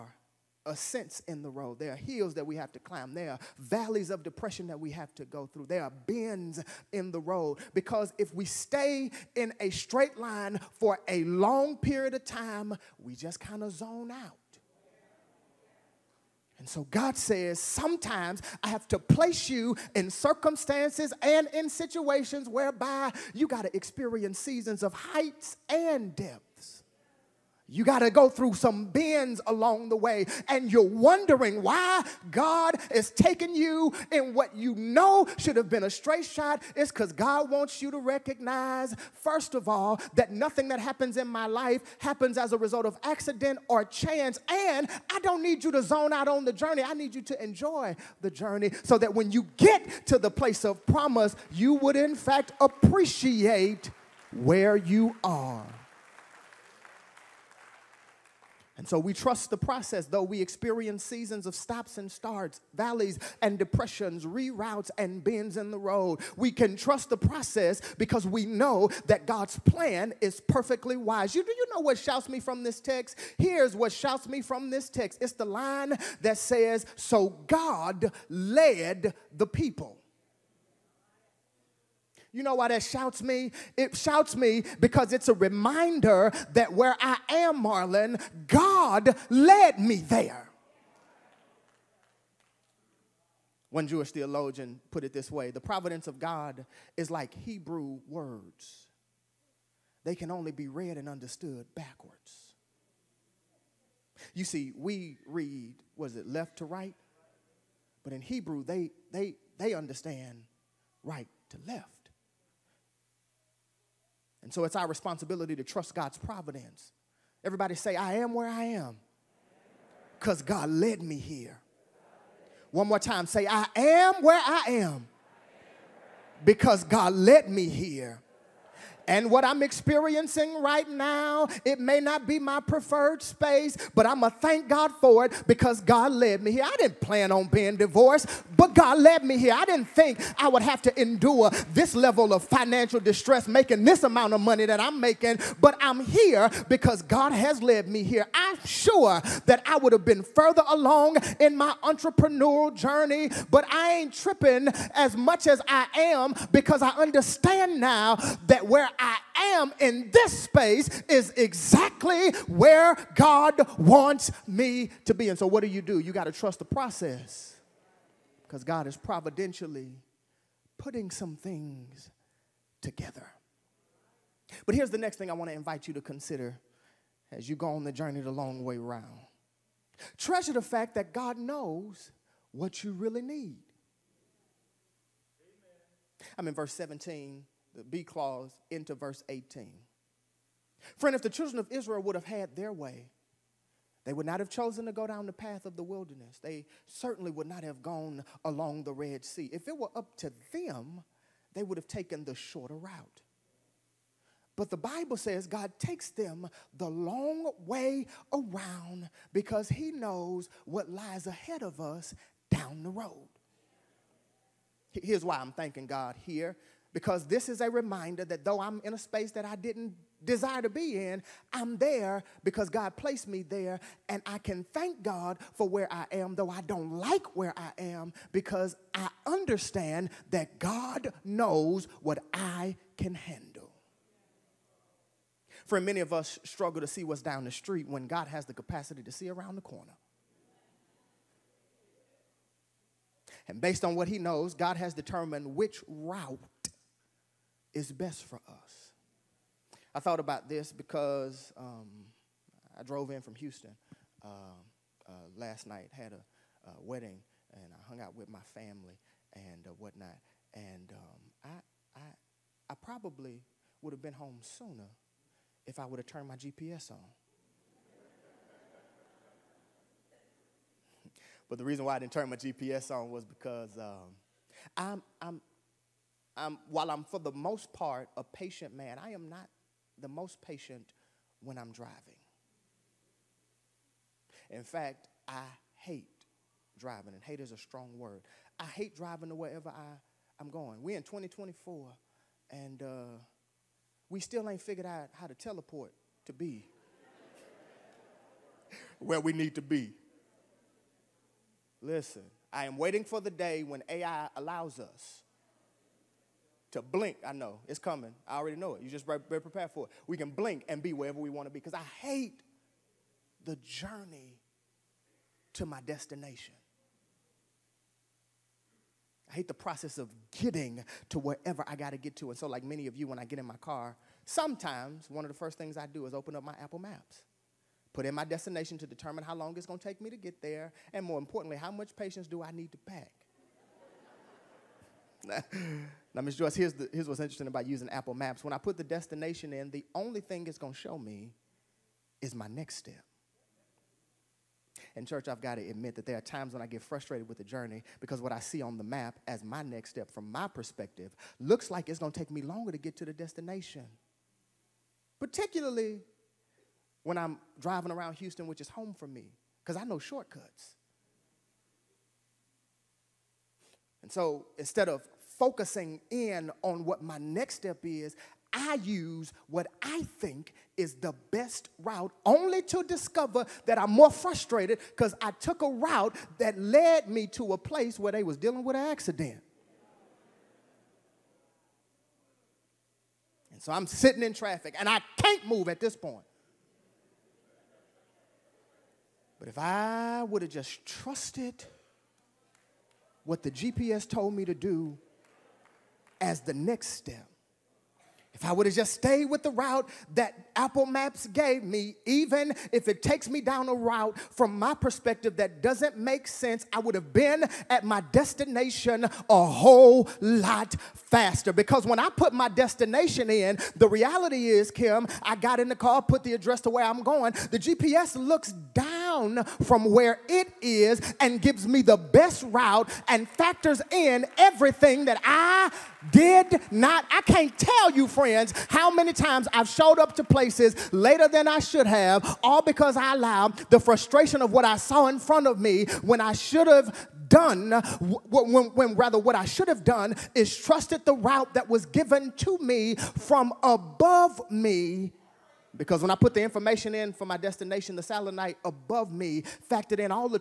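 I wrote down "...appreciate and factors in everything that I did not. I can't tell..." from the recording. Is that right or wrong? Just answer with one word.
wrong.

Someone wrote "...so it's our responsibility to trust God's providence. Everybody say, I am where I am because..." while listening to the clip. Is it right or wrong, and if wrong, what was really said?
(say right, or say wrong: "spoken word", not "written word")
right.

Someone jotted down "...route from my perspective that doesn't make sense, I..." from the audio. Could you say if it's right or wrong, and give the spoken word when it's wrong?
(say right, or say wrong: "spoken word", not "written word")
right.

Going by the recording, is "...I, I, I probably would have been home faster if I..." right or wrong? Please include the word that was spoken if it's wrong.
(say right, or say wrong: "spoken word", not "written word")
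wrong: "sooner", not "faster".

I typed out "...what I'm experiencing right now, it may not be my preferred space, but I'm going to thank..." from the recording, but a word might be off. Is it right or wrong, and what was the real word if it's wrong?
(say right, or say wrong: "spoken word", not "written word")
right.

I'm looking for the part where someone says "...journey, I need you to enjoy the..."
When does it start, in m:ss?
0:46.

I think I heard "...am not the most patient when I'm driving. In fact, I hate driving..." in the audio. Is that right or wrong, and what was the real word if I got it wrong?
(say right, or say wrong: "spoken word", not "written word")
right.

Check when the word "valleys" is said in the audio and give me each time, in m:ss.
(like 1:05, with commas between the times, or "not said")
0:03, 1:02.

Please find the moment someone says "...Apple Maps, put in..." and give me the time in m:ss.
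5:26.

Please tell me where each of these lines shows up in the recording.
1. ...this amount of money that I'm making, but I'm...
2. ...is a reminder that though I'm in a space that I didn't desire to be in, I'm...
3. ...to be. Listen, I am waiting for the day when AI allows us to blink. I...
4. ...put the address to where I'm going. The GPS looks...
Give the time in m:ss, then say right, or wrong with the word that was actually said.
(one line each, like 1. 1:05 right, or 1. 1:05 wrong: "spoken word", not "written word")
1. 2:23 right
2. 3:37 right
3. 4:59 right
4. 6:56 right.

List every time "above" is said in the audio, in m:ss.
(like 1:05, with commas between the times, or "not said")
7:23, 7:28.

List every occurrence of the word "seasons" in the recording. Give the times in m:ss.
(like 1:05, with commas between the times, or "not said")
0:24, 1:01.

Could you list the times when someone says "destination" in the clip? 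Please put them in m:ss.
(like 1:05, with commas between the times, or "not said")
5:15, 5:28, 5:38, 5:53, 6:47, 6:52, 7:27.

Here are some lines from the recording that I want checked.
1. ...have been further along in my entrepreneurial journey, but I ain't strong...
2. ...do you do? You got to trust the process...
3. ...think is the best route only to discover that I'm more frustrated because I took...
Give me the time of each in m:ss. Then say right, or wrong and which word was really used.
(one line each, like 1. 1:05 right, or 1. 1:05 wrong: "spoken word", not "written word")
1. 2:29 wrong: "tripping", not "strong"
2. 2:45 right
3. 6:10 right.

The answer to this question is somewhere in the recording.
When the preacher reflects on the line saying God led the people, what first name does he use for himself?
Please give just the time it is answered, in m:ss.
1:27.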